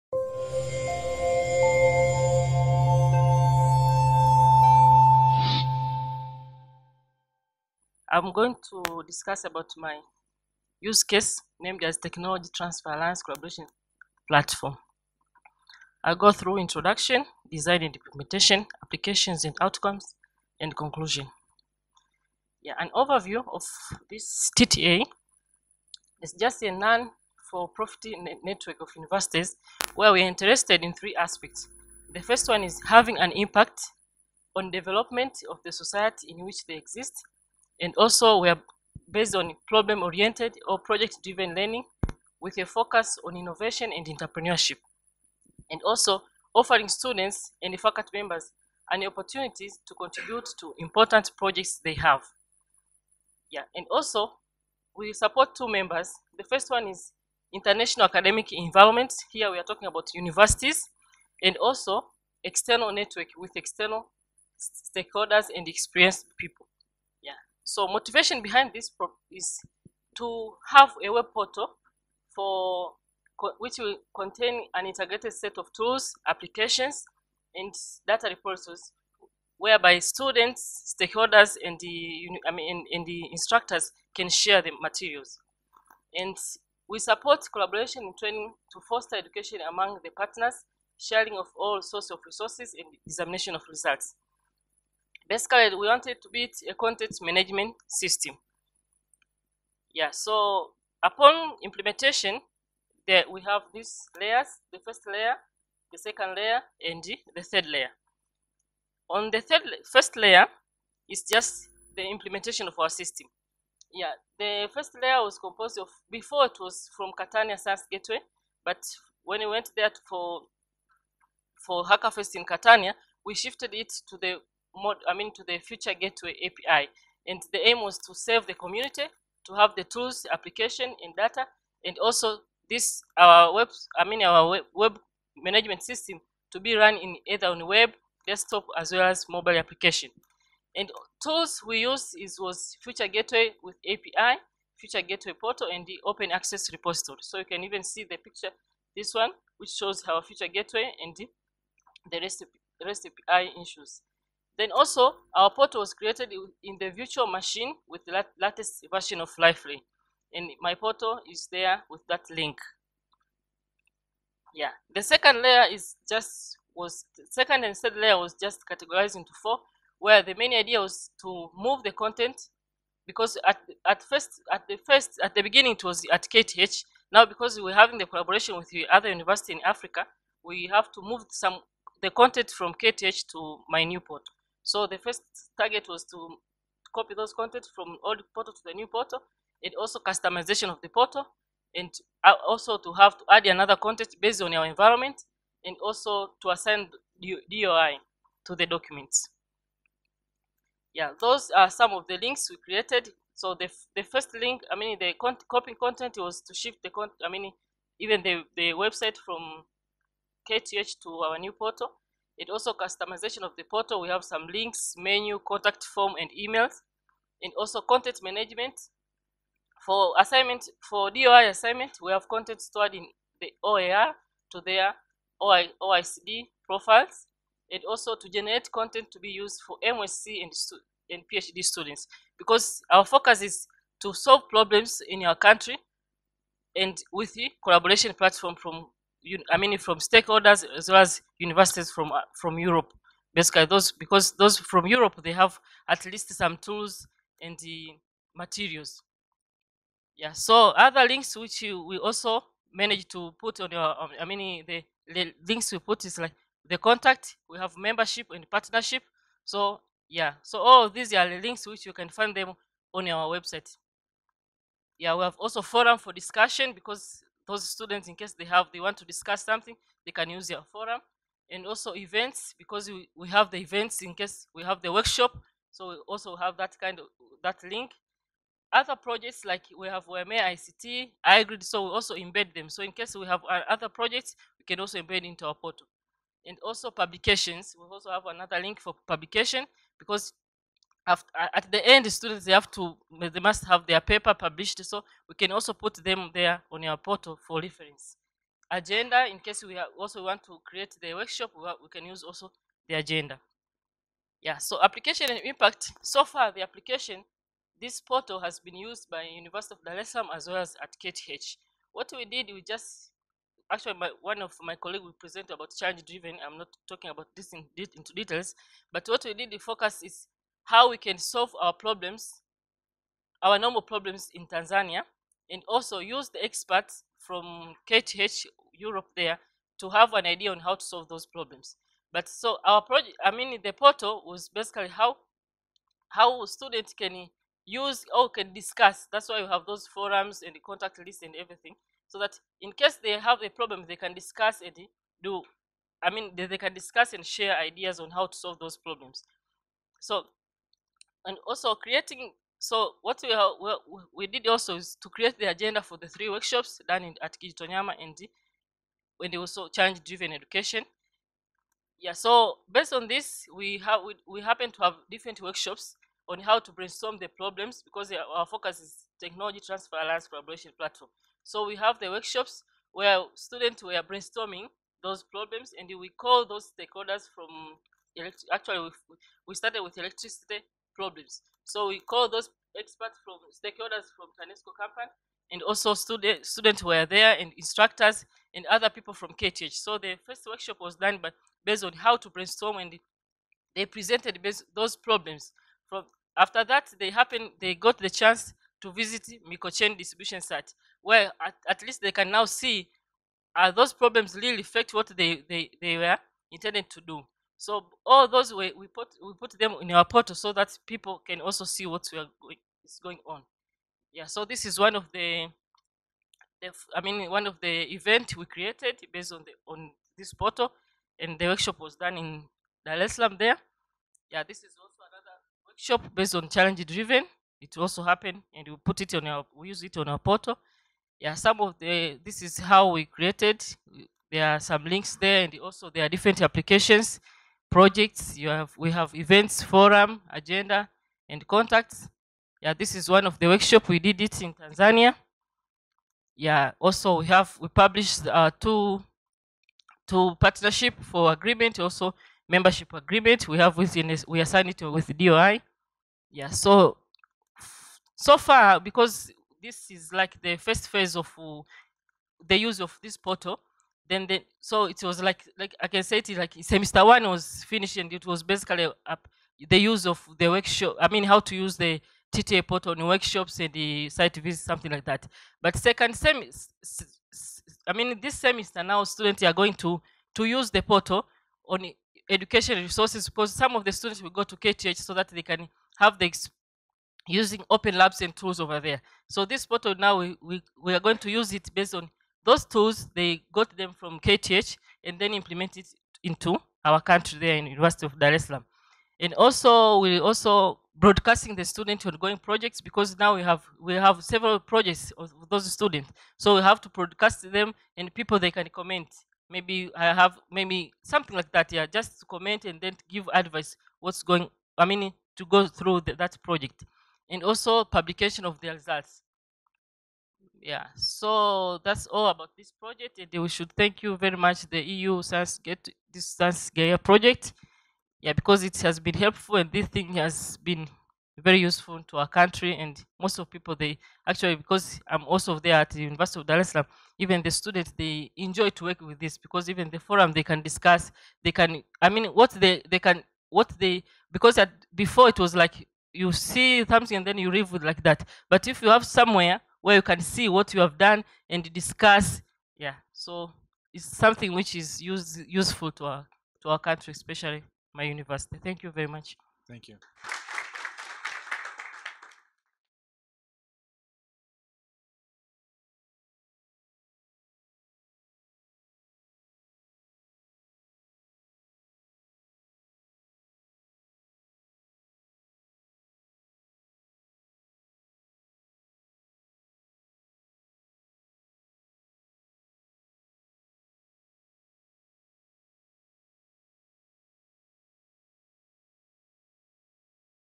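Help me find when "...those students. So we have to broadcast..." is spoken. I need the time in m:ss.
8:25.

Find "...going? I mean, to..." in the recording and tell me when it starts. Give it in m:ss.
8:34.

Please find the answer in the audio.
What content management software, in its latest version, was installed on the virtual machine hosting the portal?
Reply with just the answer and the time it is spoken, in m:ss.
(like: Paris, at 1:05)
Liferay, at 2:39.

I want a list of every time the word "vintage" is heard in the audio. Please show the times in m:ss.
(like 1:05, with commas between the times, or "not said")
not said.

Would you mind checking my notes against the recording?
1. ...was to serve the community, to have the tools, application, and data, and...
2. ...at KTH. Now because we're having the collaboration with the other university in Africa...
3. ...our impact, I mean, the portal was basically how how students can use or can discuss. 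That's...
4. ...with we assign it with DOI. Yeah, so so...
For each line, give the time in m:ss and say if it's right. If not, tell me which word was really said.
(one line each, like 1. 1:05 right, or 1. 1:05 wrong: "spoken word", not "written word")
1. 2:07 right
2. 2:56 right
3. 5:32 wrong: "project", not "impact"
4. 7:33 right.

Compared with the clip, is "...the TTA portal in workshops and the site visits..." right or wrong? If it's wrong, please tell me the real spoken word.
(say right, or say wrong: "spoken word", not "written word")
right.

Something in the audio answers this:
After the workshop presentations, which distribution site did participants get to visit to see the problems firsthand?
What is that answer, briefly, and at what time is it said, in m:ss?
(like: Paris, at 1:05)
Mikocheni, at 6:39.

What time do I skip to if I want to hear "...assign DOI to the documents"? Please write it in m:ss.
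3:16.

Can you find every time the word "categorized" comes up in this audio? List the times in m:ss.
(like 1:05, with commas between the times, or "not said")
2:48.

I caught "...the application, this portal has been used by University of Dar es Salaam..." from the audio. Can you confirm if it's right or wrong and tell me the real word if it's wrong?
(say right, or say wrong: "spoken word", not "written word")
right.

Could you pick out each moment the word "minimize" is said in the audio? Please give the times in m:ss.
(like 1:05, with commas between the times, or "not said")
not said.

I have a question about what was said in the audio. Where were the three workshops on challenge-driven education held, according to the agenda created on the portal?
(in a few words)
Kijitonyama.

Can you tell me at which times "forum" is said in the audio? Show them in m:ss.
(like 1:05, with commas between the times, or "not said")
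4:25, 4:30, 5:39, 7:19, 8:59.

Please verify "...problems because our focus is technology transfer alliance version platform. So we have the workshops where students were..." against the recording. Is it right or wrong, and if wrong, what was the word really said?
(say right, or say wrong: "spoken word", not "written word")
wrong: "collaboration", not "version".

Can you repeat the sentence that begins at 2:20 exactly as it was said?
And tools we use is was Future Gateway with API, Future Gateway Portal, and the Open Access Repository.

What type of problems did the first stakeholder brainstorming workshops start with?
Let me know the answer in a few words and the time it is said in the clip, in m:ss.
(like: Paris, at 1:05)
Electricity problems, at 6:19.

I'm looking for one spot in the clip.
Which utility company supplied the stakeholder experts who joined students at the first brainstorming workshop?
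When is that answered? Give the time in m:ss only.
6:24.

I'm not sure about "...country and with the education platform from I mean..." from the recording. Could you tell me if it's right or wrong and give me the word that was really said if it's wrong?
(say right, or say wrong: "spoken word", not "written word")
wrong: "collaboration", not "education".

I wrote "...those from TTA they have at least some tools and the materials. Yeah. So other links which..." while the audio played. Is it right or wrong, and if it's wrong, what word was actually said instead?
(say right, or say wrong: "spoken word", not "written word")
wrong: "Europe", not "TTA".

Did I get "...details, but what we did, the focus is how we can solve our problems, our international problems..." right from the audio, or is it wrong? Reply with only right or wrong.
wrong.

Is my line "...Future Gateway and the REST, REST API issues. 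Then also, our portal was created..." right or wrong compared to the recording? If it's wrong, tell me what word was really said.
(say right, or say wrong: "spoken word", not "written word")
right.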